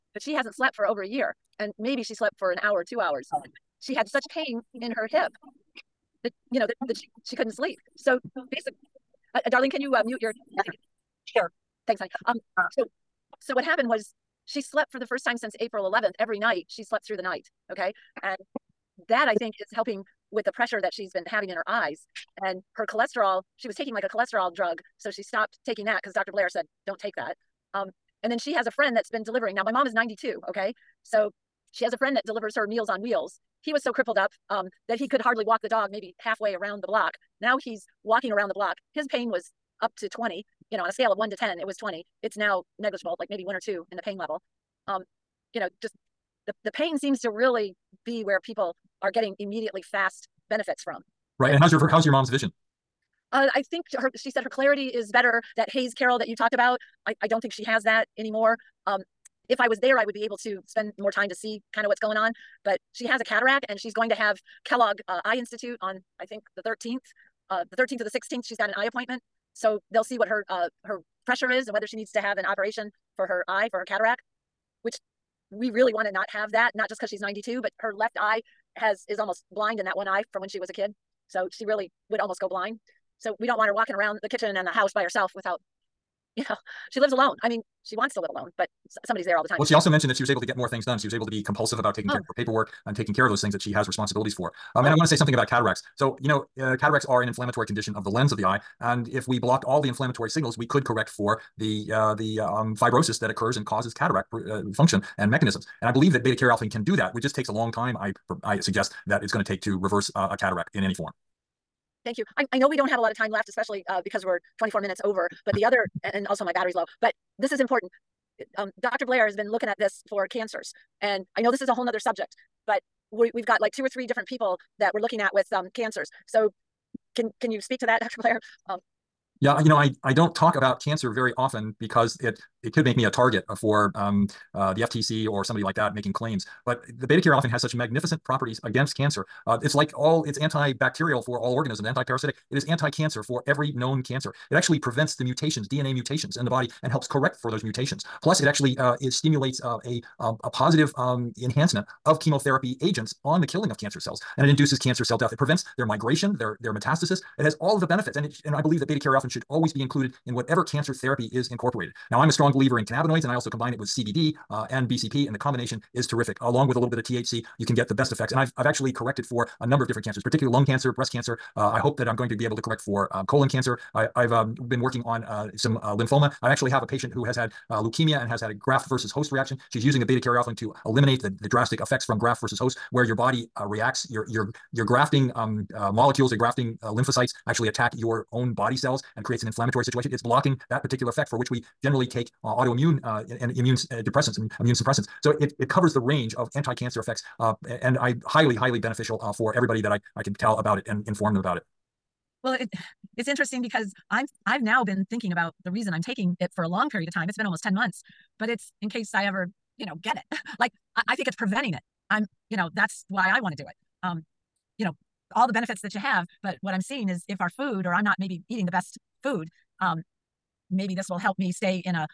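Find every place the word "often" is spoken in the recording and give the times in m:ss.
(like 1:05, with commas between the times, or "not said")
2:11, 2:17.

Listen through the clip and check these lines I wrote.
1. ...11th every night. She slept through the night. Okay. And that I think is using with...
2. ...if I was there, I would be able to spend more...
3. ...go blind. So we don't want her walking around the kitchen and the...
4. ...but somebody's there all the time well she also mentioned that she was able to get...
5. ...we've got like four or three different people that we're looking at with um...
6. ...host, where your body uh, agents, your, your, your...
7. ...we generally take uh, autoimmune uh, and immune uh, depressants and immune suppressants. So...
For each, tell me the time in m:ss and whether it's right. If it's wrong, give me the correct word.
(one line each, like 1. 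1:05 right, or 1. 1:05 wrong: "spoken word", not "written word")
1. 0:15 wrong: "helping", not "using"
2. 0:59 right
3. 1:22 right
4. 1:28 right
5. 2:03 wrong: "two", not "four"
6. 3:02 wrong: "reacts", not "agents"
7. 3:11 right.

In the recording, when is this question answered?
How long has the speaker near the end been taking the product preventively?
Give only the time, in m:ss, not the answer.
3:27.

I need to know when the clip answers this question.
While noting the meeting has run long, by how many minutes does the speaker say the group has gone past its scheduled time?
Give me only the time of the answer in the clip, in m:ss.
1:54.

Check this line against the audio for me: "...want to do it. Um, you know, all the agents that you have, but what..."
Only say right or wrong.
wrong.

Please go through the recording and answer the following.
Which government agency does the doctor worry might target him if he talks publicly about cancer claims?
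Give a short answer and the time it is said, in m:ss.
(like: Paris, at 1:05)
FTC, at 2:14.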